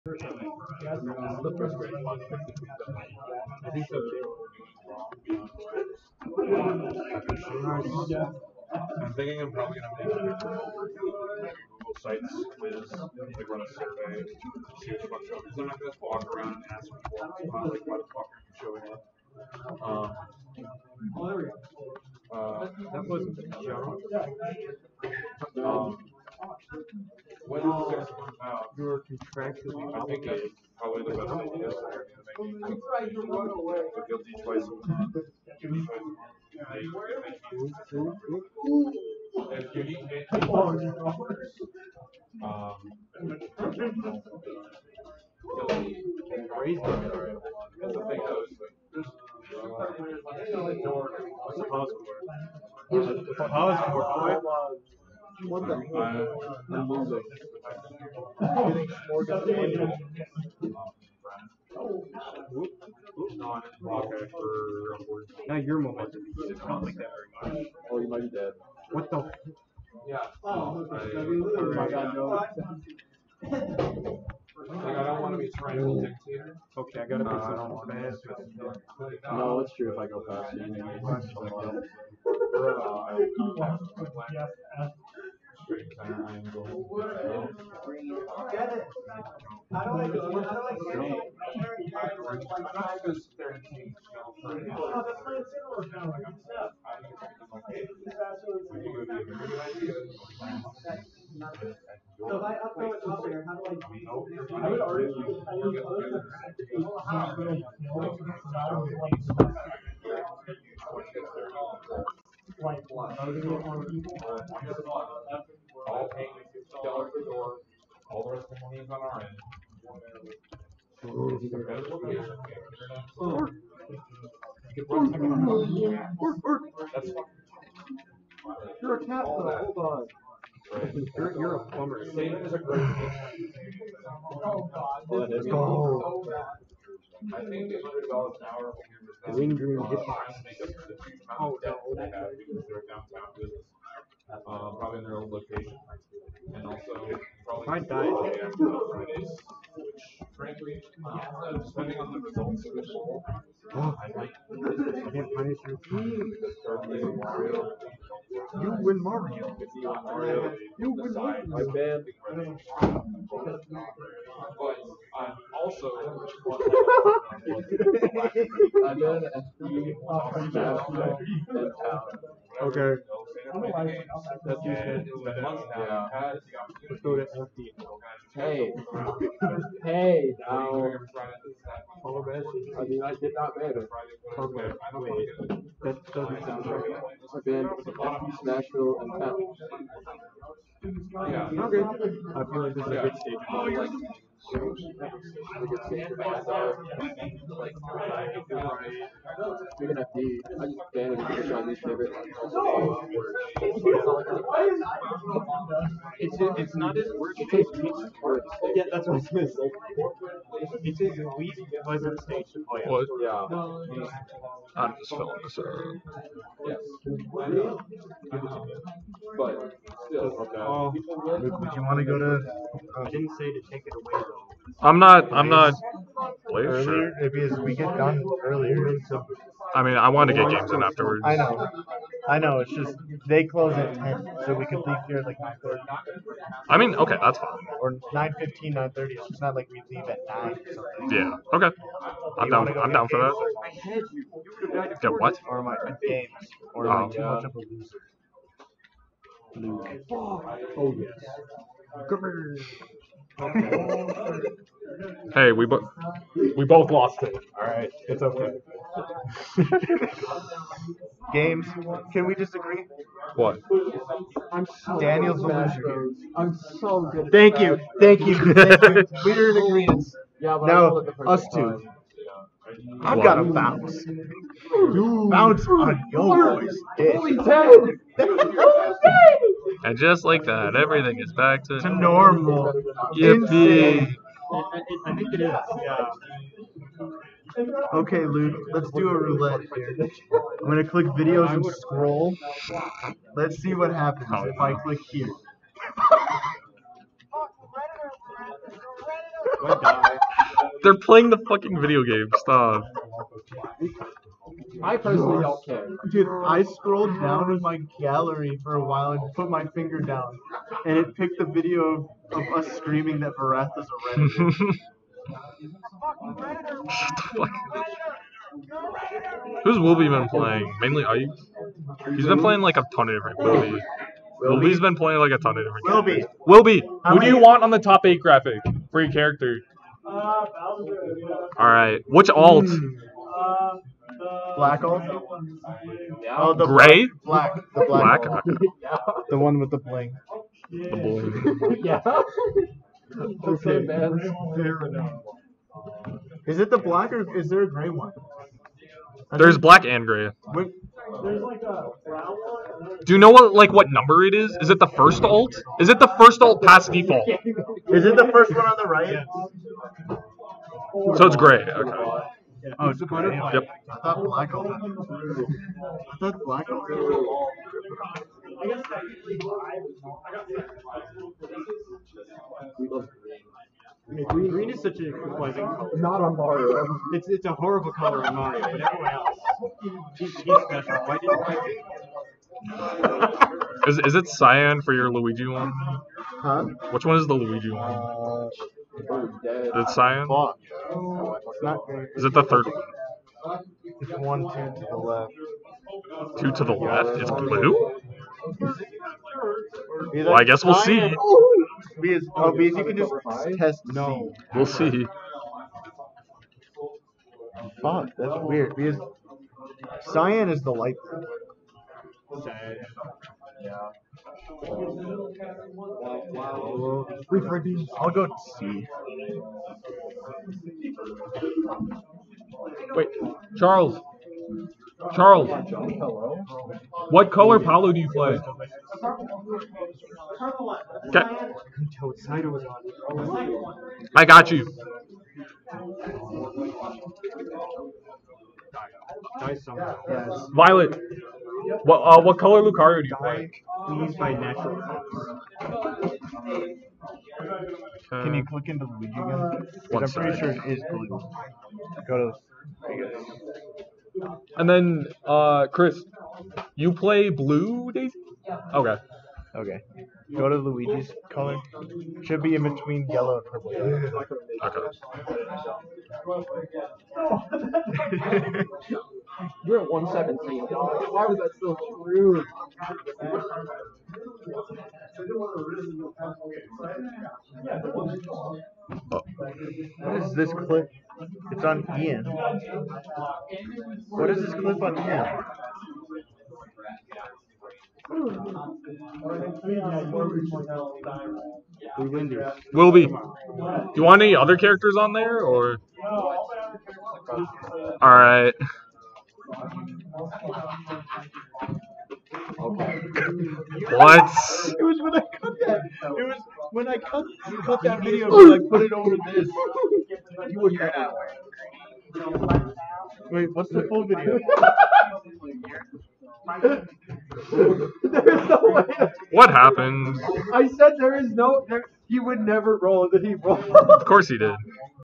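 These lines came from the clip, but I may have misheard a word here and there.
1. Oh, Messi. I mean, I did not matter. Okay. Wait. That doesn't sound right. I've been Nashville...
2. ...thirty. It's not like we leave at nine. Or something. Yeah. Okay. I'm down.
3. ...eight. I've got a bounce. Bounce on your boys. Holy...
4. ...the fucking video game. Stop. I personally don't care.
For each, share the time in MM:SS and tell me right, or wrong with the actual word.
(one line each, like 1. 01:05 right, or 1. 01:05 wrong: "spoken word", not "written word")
1. 03:02 right
2. 03:58 right
3. 04:31 wrong: "two", not "eight"
4. 05:01 right.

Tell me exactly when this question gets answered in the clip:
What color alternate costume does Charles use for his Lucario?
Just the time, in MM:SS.
07:24.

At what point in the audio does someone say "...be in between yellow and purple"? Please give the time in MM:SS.
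07:42.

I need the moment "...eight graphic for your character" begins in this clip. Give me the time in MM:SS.
05:28.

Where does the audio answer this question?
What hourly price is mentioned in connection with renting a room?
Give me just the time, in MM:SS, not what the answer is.
02:17.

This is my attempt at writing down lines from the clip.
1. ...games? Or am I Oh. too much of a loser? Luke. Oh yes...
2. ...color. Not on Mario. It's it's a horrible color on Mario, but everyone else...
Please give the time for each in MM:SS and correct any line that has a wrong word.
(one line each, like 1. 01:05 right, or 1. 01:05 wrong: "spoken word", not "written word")
1. 04:06 right
2. 06:15 right.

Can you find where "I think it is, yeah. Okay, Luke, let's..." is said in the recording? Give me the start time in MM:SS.
04:44.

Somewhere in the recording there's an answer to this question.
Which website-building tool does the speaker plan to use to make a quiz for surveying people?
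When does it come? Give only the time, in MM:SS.
00:10.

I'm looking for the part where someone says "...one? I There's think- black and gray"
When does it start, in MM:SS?
05:47.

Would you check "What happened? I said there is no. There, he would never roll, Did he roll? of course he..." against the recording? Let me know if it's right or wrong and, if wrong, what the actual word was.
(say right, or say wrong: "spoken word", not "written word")
right.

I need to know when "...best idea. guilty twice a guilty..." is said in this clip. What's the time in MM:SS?
00:31.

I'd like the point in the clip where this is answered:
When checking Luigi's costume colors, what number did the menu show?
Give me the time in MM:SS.
07:49.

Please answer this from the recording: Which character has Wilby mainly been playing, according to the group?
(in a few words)
Ike.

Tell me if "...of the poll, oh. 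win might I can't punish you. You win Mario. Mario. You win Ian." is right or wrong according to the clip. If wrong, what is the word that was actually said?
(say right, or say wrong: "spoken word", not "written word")
wrong: "Mario", not "Ian".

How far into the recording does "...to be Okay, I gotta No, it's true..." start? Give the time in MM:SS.
01:15.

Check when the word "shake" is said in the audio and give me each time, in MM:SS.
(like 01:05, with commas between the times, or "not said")
not said.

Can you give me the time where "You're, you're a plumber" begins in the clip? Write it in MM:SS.
02:11.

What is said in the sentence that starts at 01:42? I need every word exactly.
So if I upload it up there, how do I?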